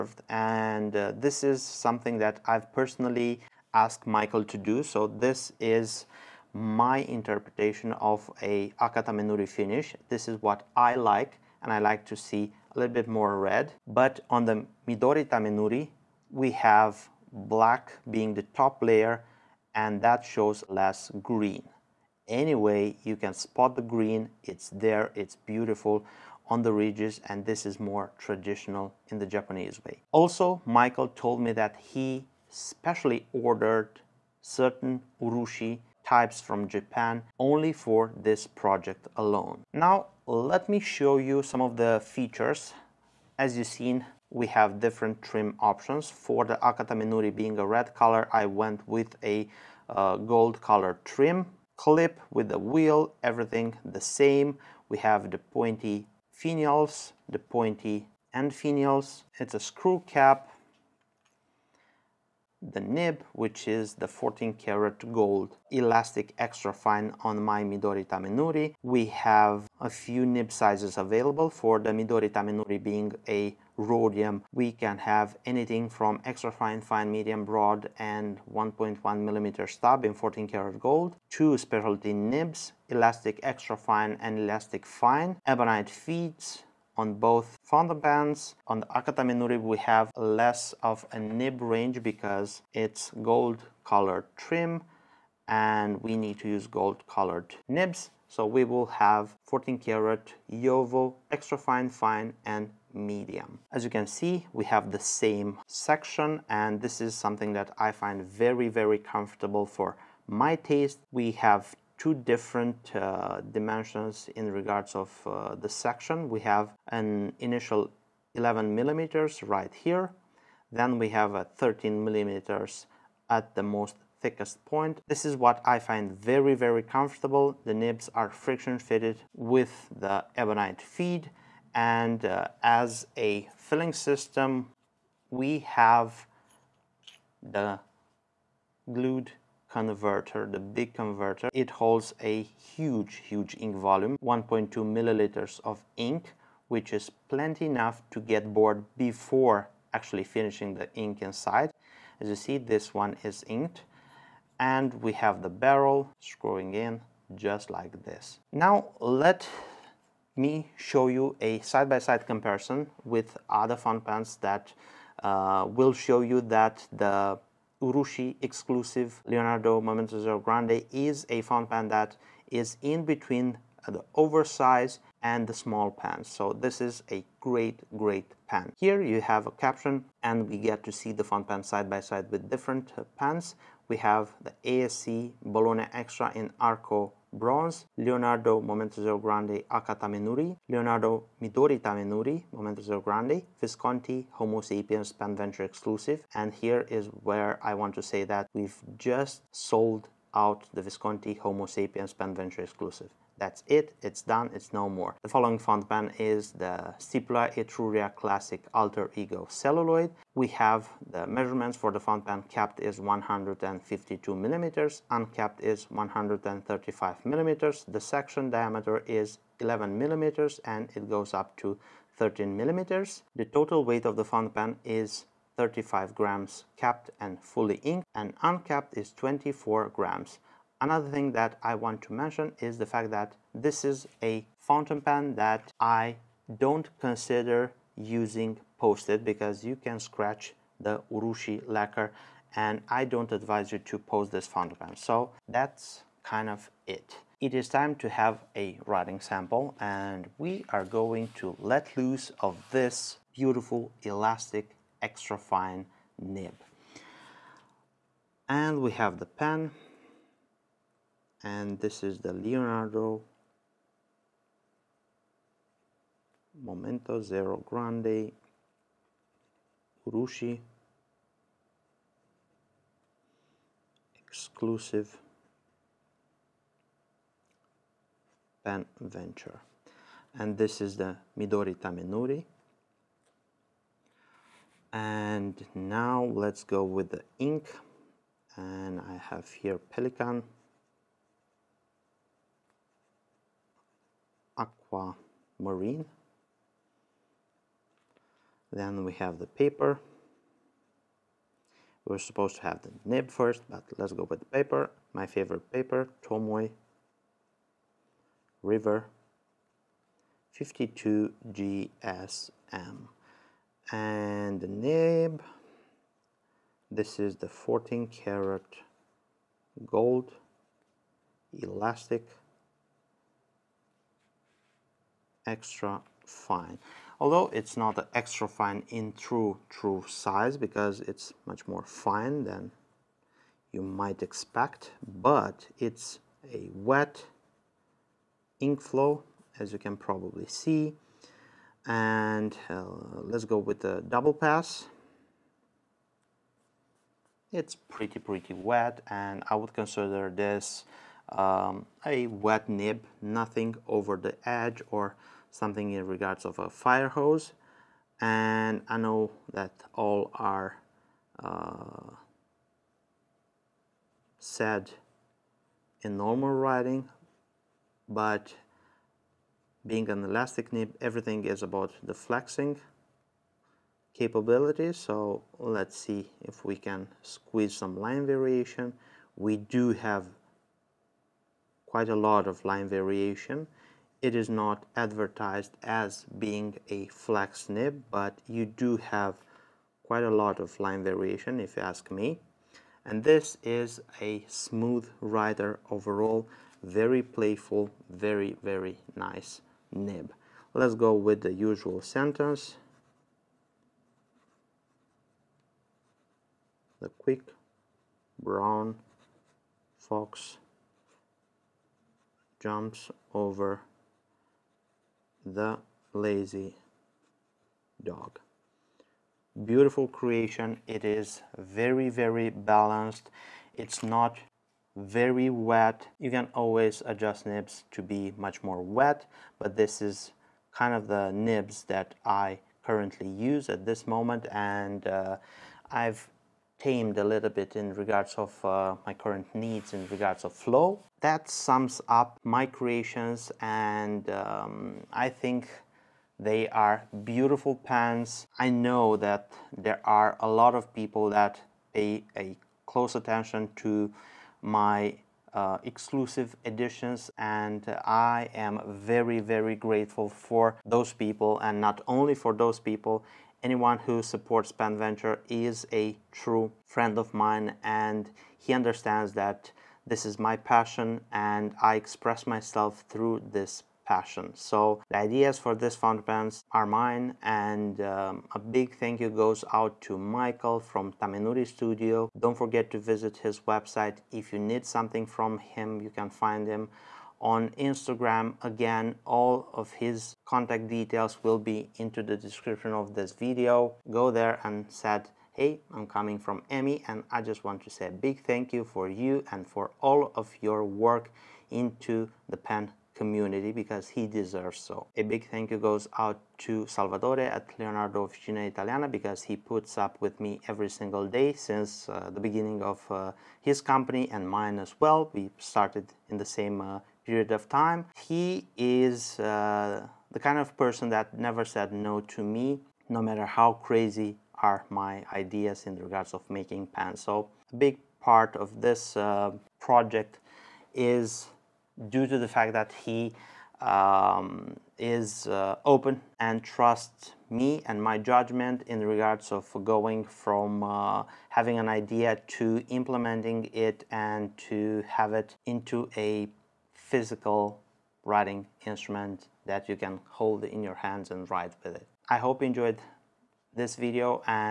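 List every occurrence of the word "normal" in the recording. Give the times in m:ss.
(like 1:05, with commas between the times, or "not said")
6:06.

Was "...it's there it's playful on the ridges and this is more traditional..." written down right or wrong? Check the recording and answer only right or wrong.
wrong.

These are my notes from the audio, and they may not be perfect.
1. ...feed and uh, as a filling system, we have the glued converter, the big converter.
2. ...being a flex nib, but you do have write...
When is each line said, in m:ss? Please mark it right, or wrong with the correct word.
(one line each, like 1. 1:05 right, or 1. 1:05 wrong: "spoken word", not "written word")
1. 2:10 right
2. 6:26 wrong: "quite", not "write".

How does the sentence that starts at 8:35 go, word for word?
We started in the same uh, period of time.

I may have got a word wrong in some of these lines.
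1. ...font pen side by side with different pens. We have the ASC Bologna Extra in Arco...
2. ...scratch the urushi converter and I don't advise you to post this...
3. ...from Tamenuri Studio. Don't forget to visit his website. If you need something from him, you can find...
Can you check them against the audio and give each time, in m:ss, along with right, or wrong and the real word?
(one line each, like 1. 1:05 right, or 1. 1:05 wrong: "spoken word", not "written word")
1. 3:01 right
2. 3:59 wrong: "lacquer", not "converter"
3. 8:00 right.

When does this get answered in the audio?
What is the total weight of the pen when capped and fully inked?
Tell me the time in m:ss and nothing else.
3:45.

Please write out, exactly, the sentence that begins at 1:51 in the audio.
We have two different uh, dimensions in regards of uh, the section.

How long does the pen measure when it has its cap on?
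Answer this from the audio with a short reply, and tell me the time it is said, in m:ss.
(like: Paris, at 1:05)
152 millimeters, at 3:32.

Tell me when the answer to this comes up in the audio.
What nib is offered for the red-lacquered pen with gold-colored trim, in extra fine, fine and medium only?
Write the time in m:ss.
1:39.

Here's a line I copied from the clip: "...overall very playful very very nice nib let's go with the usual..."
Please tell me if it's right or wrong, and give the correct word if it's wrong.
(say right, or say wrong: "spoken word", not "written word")
right.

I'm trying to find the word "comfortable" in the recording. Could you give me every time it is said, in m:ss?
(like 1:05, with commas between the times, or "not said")
1:48, 2:06.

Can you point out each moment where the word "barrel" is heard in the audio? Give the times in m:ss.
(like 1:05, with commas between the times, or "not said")
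2:35.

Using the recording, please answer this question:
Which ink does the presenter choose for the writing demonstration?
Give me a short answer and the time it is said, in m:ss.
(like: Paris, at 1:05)
Pelikan Marine, at 4:49.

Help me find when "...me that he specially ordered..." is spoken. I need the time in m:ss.
0:31.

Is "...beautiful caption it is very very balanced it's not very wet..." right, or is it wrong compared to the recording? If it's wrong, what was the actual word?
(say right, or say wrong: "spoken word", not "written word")
wrong: "creation", not "caption".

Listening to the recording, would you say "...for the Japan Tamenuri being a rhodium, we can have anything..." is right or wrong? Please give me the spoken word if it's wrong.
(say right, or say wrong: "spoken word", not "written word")
wrong: "Midori", not "Japan".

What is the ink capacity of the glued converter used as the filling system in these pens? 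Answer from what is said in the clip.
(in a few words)
1.2 milliliters.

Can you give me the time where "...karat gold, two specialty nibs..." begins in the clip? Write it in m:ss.
1:20.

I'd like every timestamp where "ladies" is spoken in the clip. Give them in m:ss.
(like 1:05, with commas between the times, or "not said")
not said.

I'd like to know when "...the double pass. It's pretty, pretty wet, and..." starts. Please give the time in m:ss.
5:43.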